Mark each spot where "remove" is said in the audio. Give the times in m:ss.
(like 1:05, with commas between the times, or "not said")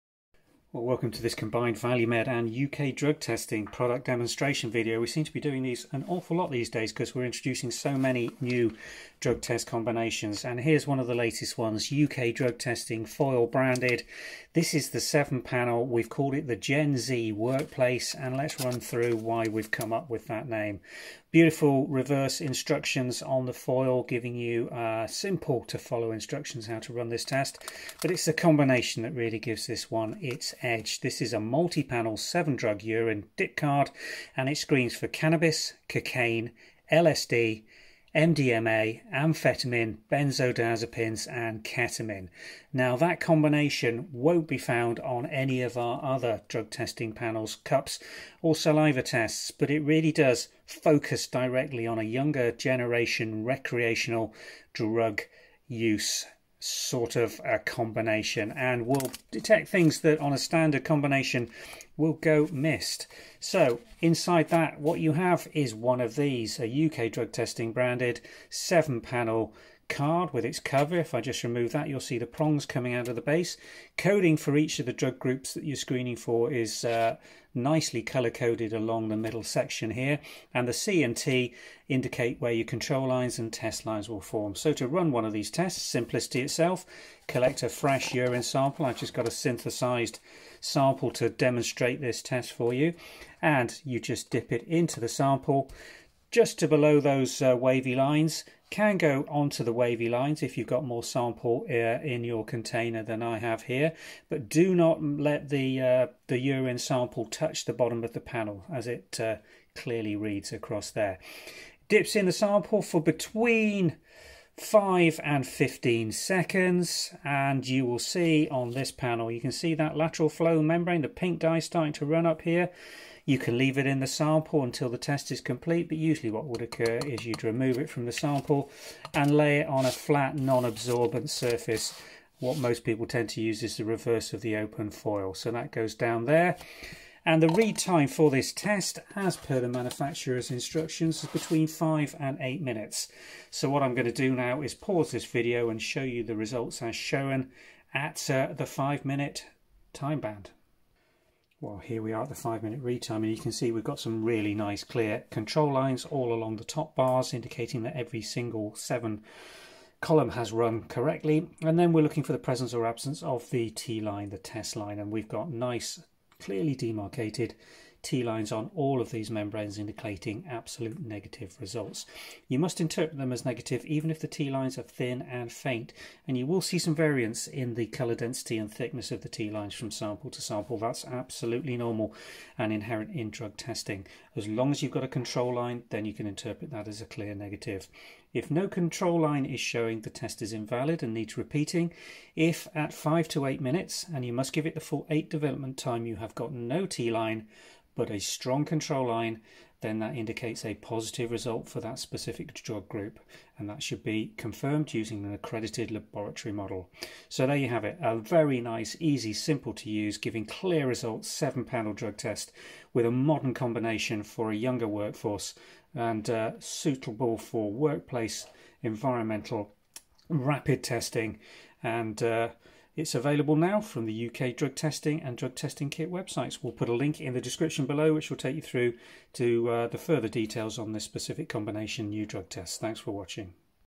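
1:11, 2:07.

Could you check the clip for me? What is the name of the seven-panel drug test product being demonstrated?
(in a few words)
Gen Z Workplace.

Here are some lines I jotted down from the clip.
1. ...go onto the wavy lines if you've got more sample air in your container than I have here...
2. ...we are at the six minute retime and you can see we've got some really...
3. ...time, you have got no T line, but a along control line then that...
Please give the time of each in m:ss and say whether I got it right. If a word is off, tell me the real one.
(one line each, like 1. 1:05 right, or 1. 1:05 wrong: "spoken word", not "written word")
1. 1:38 right
2. 2:32 wrong: "five", not "six"
3. 3:15 wrong: "strong", not "along".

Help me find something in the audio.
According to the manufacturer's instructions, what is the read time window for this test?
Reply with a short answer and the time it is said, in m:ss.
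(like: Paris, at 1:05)
5 to 8 minutes, at 2:21.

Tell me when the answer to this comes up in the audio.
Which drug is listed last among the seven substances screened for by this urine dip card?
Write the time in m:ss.
0:41.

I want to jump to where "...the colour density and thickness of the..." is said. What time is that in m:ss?
2:57.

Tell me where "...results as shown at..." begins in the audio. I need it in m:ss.
2:26.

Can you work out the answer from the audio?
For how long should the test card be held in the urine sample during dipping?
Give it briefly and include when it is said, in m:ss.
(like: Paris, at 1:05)
5 to 15 seconds, at 1:53.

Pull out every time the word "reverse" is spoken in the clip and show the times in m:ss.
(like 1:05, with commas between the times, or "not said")
0:21, 2:13.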